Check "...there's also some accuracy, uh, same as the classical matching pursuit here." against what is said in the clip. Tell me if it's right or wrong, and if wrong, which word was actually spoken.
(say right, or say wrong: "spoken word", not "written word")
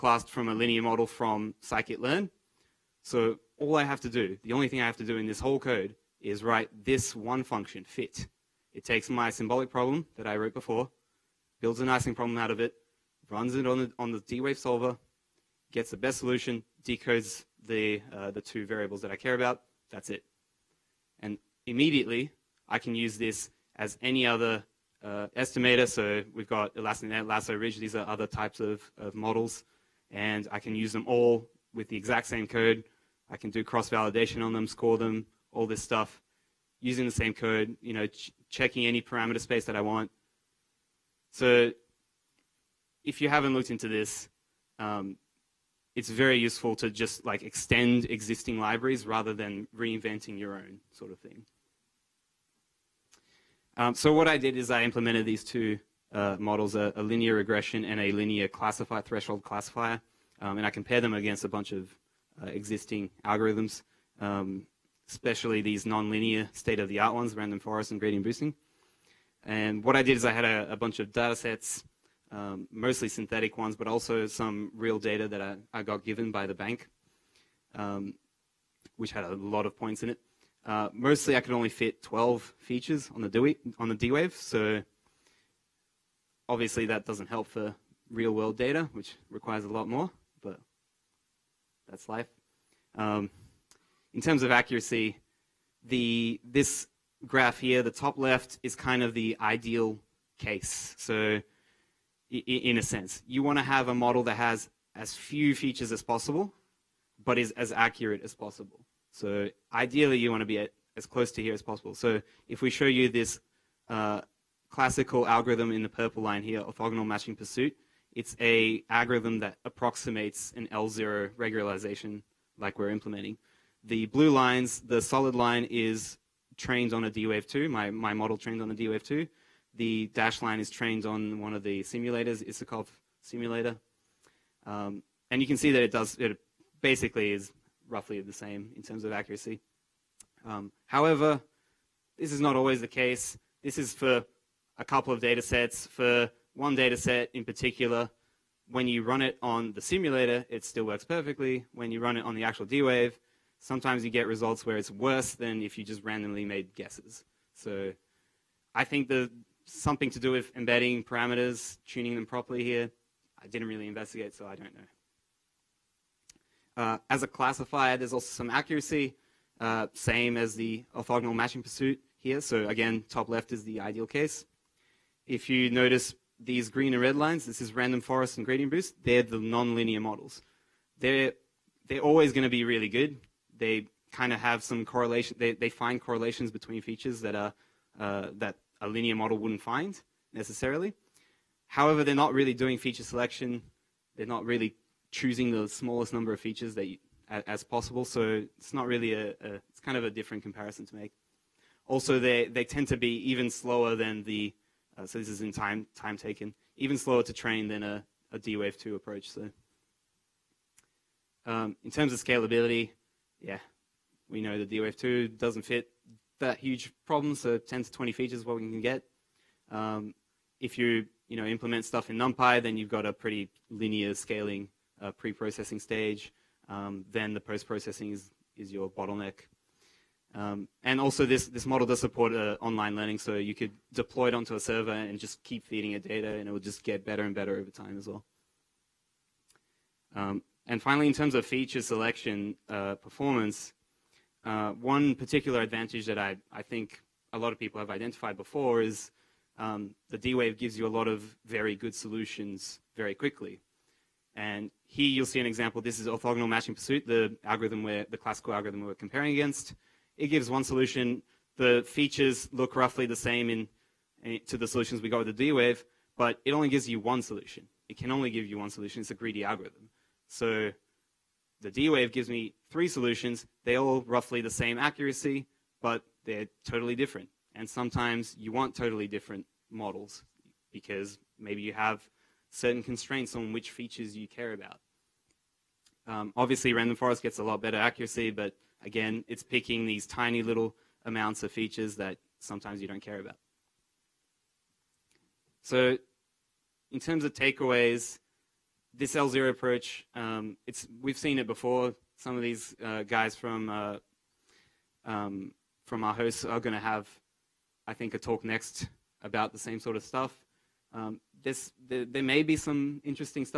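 wrong: "orthogonal", not "classical".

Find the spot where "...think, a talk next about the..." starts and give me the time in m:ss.
5:07.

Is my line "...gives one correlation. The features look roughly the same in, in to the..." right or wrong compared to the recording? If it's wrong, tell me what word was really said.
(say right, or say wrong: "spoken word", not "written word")
wrong: "solution", not "correlation".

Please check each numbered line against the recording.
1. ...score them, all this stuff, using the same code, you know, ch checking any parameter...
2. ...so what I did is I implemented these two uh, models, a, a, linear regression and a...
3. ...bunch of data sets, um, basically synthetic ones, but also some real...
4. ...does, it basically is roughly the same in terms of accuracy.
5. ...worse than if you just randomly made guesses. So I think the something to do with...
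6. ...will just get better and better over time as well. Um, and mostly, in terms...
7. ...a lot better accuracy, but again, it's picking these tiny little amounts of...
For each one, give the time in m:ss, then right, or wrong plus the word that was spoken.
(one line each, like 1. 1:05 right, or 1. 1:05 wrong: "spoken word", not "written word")
1. 0:34 right
2. 0:53 right
3. 1:10 wrong: "mostly", not "basically"
4. 2:15 right
5. 2:34 right
6. 3:56 wrong: "finally", not "mostly"
7. 4:47 right.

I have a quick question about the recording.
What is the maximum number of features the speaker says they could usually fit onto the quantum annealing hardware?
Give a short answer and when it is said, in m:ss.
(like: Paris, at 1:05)
12, at 1:22.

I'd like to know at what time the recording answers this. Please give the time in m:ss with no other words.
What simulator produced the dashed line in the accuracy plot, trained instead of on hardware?
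2:12.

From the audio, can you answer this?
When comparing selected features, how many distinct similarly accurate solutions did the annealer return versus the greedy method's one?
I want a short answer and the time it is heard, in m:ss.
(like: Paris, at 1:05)
3, at 4:32.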